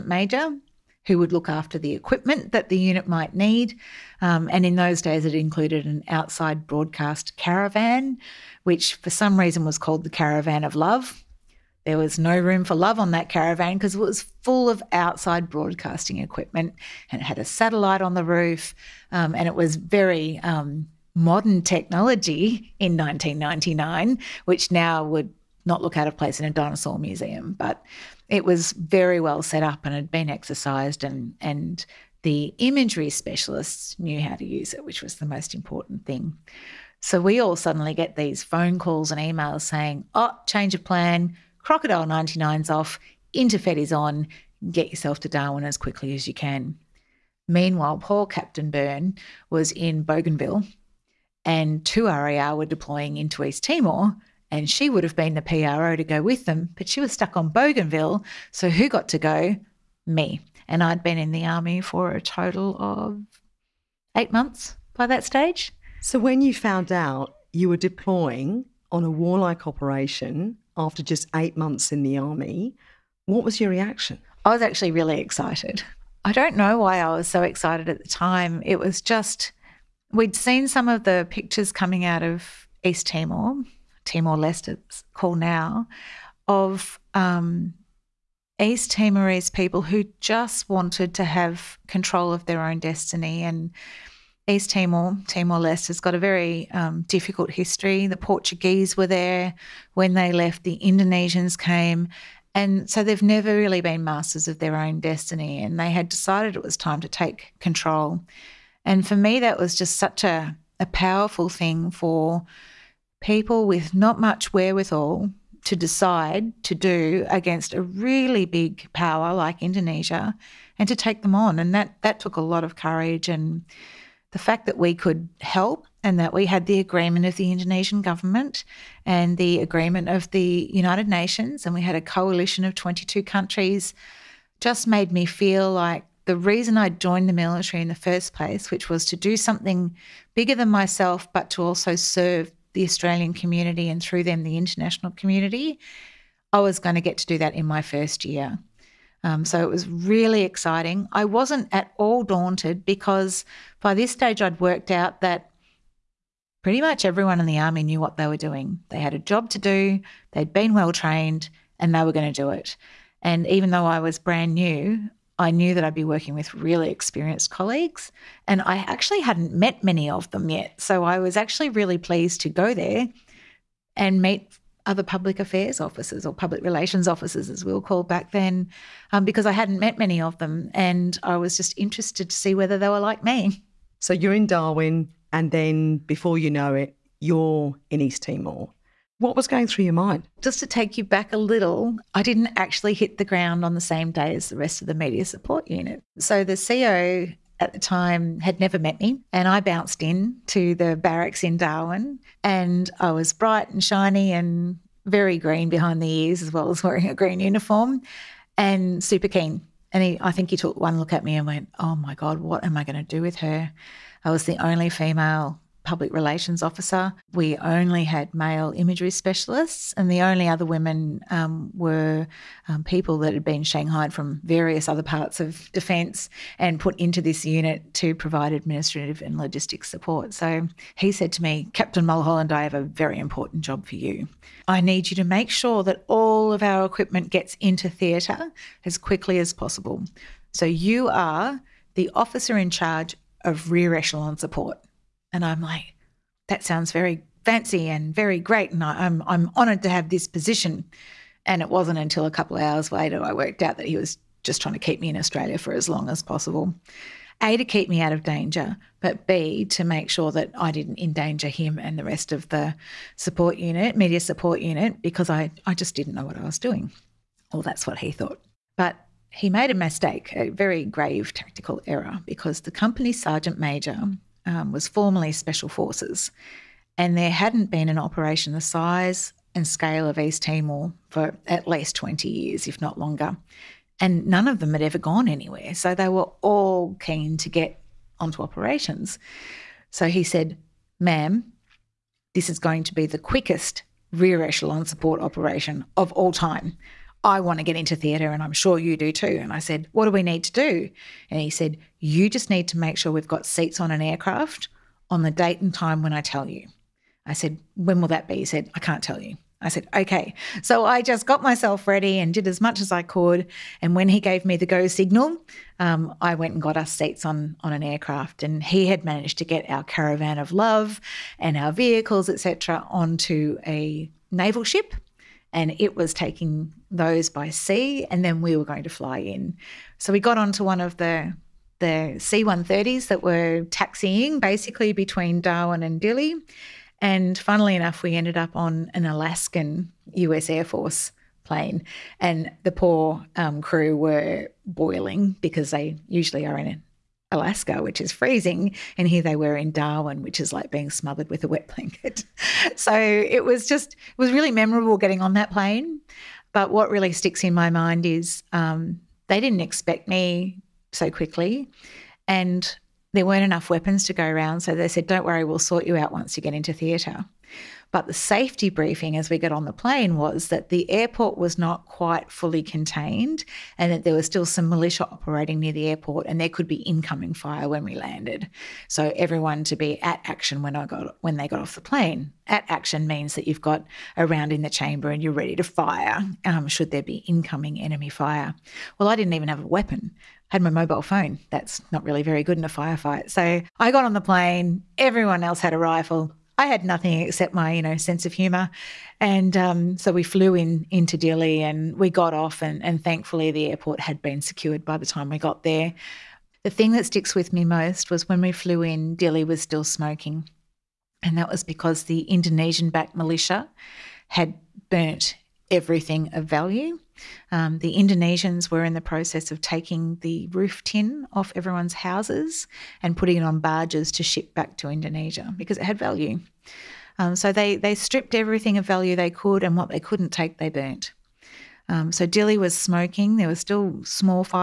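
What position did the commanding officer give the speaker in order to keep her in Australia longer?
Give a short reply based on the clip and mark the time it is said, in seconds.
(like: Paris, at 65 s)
officer in charge of rear echelon support, at 242 s.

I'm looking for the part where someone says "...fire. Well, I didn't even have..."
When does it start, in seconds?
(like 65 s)
388 s.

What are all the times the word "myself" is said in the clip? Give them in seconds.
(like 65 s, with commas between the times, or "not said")
140 s, 311 s.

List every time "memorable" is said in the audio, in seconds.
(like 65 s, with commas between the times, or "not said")
354 s.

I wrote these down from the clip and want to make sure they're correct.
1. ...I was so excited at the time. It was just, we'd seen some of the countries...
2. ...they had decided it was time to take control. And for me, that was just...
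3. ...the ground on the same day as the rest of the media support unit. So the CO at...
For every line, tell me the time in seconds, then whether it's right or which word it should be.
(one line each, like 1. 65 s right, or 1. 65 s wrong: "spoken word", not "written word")
1. 76 s wrong: "pictures", not "countries"
2. 105 s right
3. 193 s right.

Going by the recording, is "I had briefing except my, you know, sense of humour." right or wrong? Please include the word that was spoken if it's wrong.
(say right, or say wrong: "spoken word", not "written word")
wrong: "nothing", not "briefing".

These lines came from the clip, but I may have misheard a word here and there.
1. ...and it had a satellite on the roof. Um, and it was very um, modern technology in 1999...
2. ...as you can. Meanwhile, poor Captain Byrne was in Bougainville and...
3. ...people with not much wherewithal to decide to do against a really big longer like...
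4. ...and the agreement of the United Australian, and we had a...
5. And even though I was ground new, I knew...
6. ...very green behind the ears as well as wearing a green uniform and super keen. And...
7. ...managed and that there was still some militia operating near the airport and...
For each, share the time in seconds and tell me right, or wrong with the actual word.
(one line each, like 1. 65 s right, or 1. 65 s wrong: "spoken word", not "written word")
1. 17 s right
2. 46 s right
3. 113 s wrong: "power", not "longer"
4. 129 s wrong: "Nations", not "Australian"
5. 163 s wrong: "brand", not "ground"
6. 205 s right
7. 372 s wrong: "contained", not "managed".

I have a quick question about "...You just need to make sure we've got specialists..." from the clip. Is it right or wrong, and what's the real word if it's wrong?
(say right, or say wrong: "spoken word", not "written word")
wrong: "seats", not "specialists".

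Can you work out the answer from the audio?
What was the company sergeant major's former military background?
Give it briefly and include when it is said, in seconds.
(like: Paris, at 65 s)
Special Forces, at 275 s.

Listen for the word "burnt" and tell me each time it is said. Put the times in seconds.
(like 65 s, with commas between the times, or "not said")
414 s, 430 s.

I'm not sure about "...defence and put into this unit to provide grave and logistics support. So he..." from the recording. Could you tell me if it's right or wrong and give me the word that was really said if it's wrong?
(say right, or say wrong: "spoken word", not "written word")
wrong: "administrative", not "grave".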